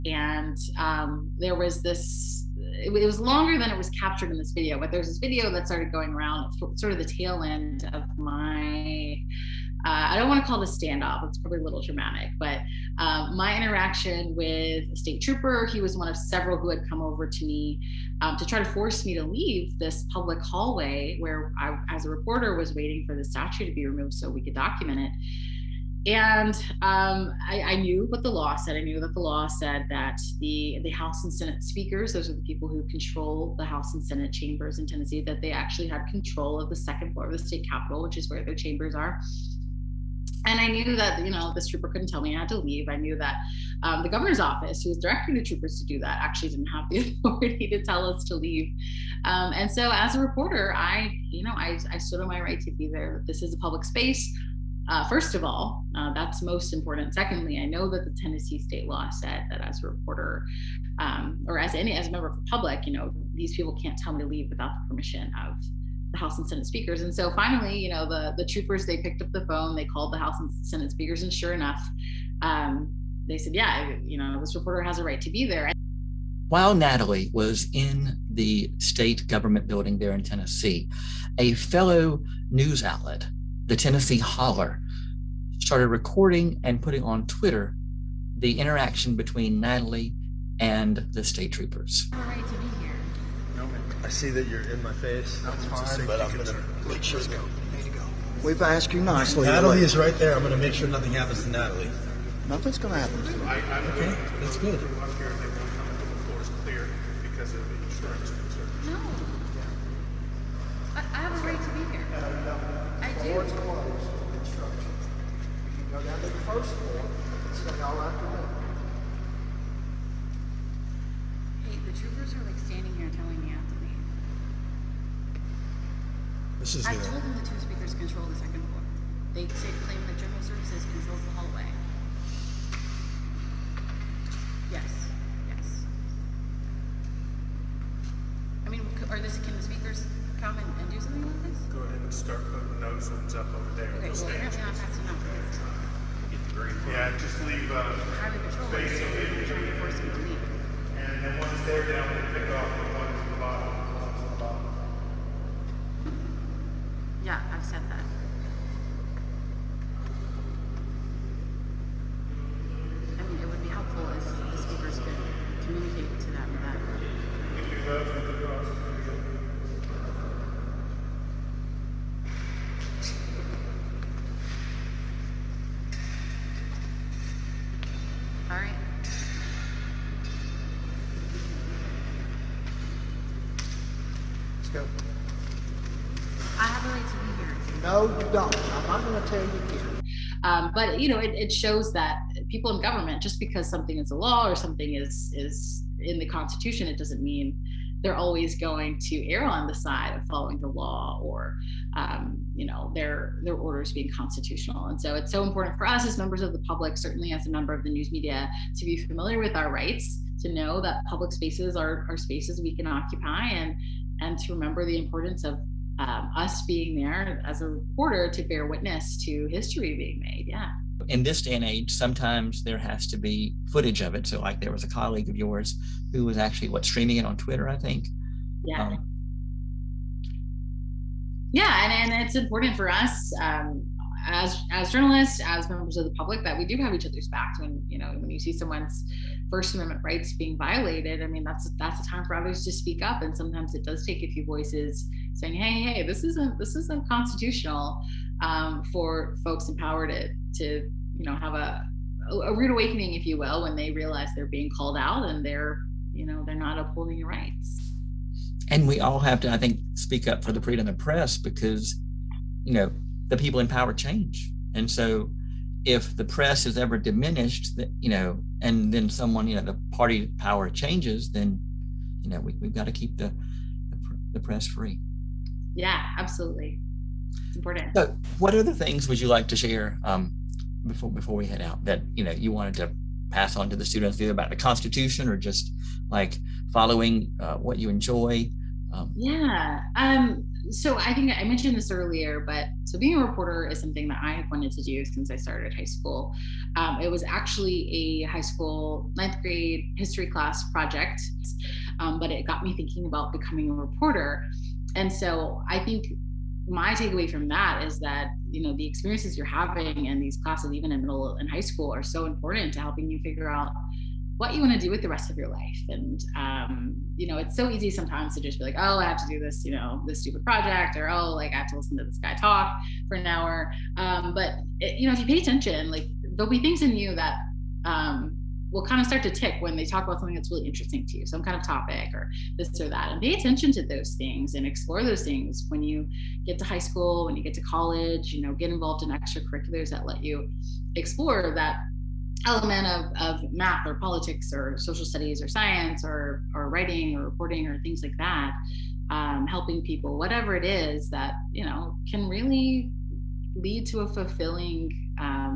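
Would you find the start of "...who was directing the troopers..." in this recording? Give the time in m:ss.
0:44.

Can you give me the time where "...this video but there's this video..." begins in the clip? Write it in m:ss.
0:04.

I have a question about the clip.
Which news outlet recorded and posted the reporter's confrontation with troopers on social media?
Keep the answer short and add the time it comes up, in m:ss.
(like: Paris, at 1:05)
Tennessee Holler, at 1:23.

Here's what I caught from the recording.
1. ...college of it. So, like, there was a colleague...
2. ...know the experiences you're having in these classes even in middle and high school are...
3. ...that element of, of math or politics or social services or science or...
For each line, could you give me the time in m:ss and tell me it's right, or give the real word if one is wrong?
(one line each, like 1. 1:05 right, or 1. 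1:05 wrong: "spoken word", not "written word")
1. 3:43 wrong: "footage", not "college"
2. 5:08 right
3. 5:41 wrong: "studies", not "services".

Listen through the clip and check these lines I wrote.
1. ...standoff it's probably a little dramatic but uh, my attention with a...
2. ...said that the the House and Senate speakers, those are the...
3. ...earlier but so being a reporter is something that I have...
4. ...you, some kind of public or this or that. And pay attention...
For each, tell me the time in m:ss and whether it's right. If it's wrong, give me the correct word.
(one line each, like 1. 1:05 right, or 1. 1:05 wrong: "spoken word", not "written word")
1. 0:10 wrong: "interaction", not "attention"
2. 0:29 right
3. 4:51 right
4. 5:31 wrong: "topic", not "public".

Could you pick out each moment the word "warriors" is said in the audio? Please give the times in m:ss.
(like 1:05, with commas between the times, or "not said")
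not said.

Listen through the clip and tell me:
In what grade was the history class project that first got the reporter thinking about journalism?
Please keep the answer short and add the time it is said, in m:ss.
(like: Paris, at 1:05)
9th grade, at 4:59.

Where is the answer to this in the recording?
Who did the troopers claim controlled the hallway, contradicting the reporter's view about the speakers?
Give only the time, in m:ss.
2:10.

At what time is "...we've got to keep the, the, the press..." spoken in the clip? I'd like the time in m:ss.
4:32.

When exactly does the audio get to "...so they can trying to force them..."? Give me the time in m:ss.
2:28.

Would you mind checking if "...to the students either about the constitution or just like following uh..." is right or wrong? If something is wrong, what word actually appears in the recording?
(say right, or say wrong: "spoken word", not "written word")
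right.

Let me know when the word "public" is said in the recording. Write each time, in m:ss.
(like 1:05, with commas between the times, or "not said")
0:20, 0:53, 1:02, 3:26, 3:31, 3:56.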